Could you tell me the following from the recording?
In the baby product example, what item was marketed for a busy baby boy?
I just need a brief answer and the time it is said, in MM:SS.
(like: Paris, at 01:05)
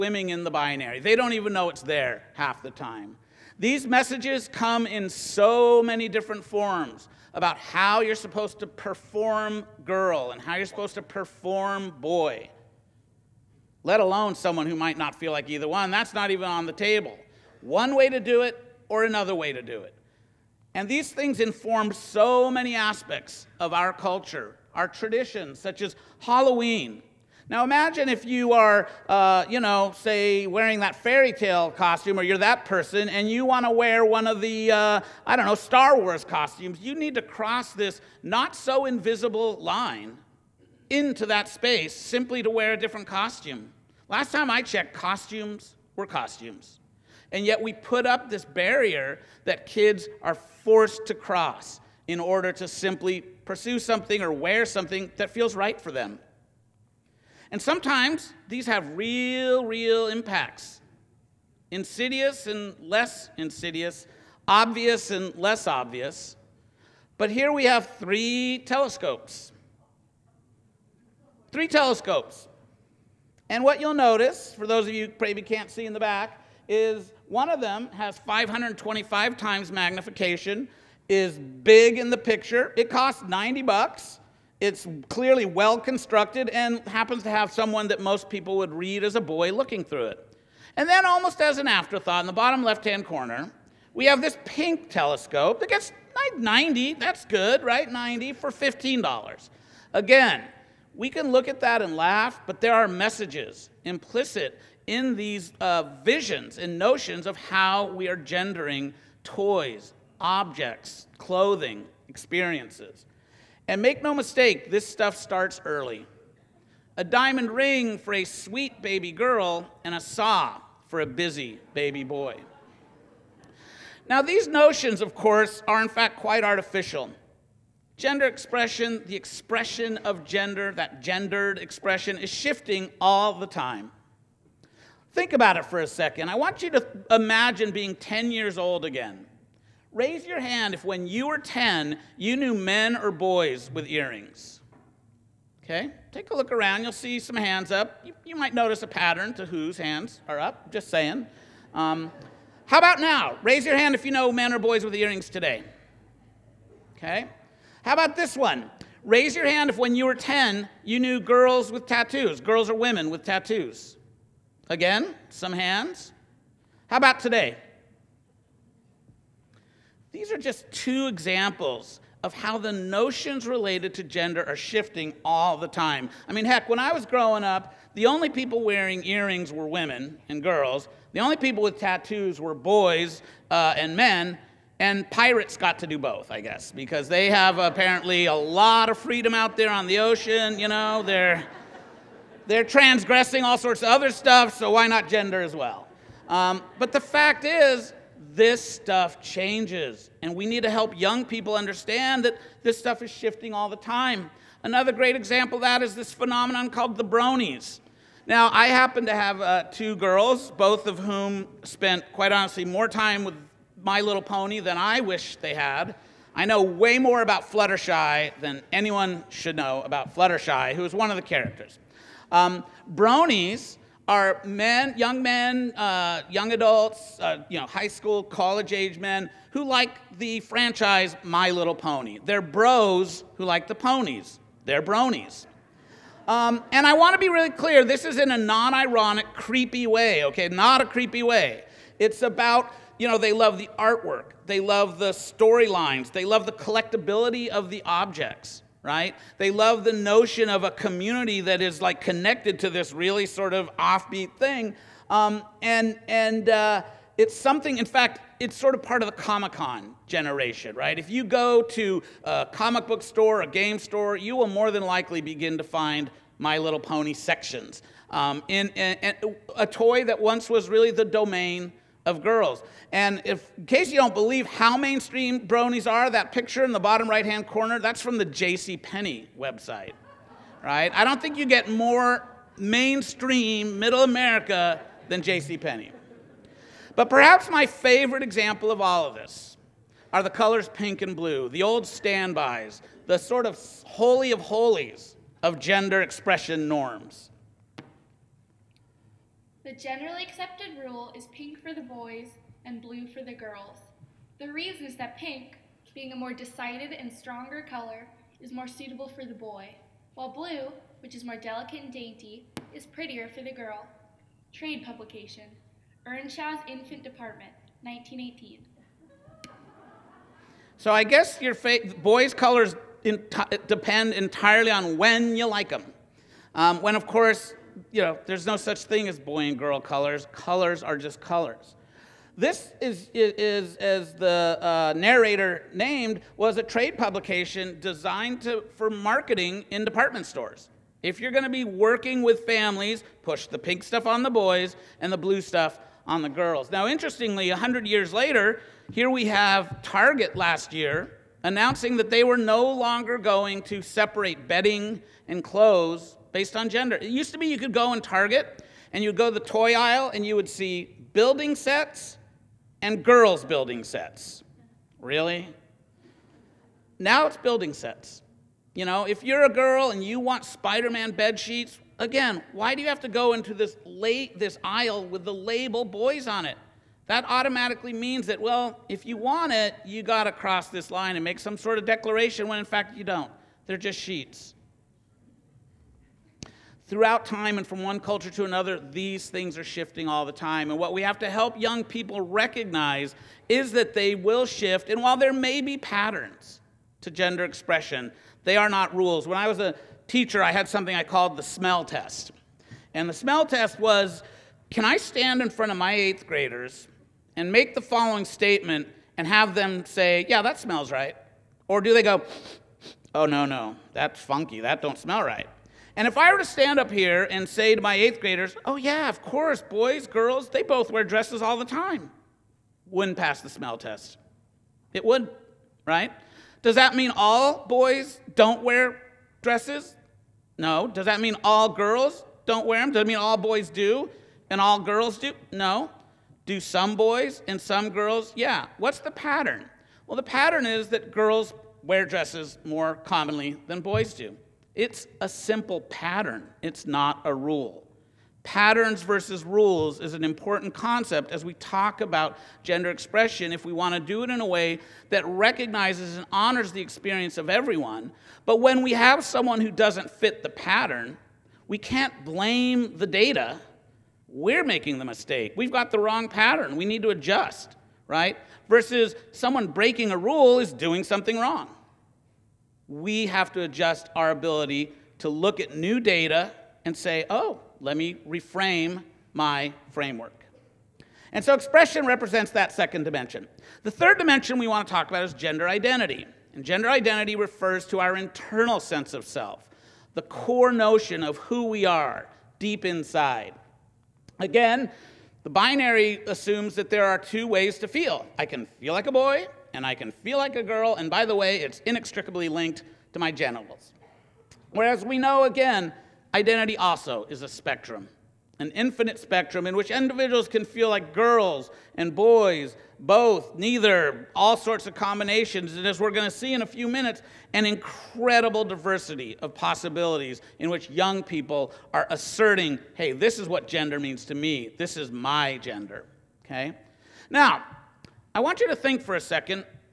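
A saw, at 01:59.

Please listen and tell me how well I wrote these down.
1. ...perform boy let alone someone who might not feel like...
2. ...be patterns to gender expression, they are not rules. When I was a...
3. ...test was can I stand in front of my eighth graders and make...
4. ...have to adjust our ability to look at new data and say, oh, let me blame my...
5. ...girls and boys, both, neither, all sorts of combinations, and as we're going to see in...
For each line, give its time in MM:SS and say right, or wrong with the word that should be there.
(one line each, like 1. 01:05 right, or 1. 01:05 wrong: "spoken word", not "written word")
1. 00:11 right
2. 06:35 right
3. 06:43 right
4. 07:53 wrong: "reframe", not "blame"
5. 08:31 right.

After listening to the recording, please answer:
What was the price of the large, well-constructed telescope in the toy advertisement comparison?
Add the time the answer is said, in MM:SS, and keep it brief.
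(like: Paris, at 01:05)
$90, at 01:23.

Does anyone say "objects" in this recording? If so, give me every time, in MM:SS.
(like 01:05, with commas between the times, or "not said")
01:50, 04:07.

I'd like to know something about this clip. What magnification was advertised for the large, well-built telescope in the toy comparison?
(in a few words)
525 times.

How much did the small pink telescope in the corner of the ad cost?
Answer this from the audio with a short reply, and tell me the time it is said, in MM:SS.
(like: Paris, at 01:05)
$15, at 01:38.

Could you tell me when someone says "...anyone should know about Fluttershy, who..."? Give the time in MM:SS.
03:38.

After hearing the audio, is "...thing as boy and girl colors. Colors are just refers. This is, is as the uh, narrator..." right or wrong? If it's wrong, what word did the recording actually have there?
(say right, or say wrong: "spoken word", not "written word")
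wrong: "colors", not "refers".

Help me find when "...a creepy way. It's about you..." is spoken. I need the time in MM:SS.
04:00.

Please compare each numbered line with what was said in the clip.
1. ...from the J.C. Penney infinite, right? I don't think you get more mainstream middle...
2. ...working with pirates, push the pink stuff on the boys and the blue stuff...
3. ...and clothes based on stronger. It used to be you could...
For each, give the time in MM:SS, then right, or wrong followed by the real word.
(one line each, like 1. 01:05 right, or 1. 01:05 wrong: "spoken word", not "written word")
1. 04:38 wrong: "website", not "infinite"
2. 05:41 wrong: "families", not "pirates"
3. 05:55 wrong: "gender", not "stronger".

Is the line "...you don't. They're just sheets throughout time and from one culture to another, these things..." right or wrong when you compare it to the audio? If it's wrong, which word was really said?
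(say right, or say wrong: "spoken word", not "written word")
right.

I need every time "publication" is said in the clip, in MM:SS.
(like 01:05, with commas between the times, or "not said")
05:14, 05:36.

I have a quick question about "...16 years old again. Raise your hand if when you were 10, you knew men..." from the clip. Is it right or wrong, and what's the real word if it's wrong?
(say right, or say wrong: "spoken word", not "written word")
wrong: "10", not "16".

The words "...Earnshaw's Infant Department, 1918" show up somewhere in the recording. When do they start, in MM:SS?
05:16.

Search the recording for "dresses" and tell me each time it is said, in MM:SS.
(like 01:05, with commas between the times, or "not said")
07:01, 07:09, 07:22.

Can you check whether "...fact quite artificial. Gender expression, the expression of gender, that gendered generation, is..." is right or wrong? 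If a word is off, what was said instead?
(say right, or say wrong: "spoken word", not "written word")
wrong: "expression", not "generation".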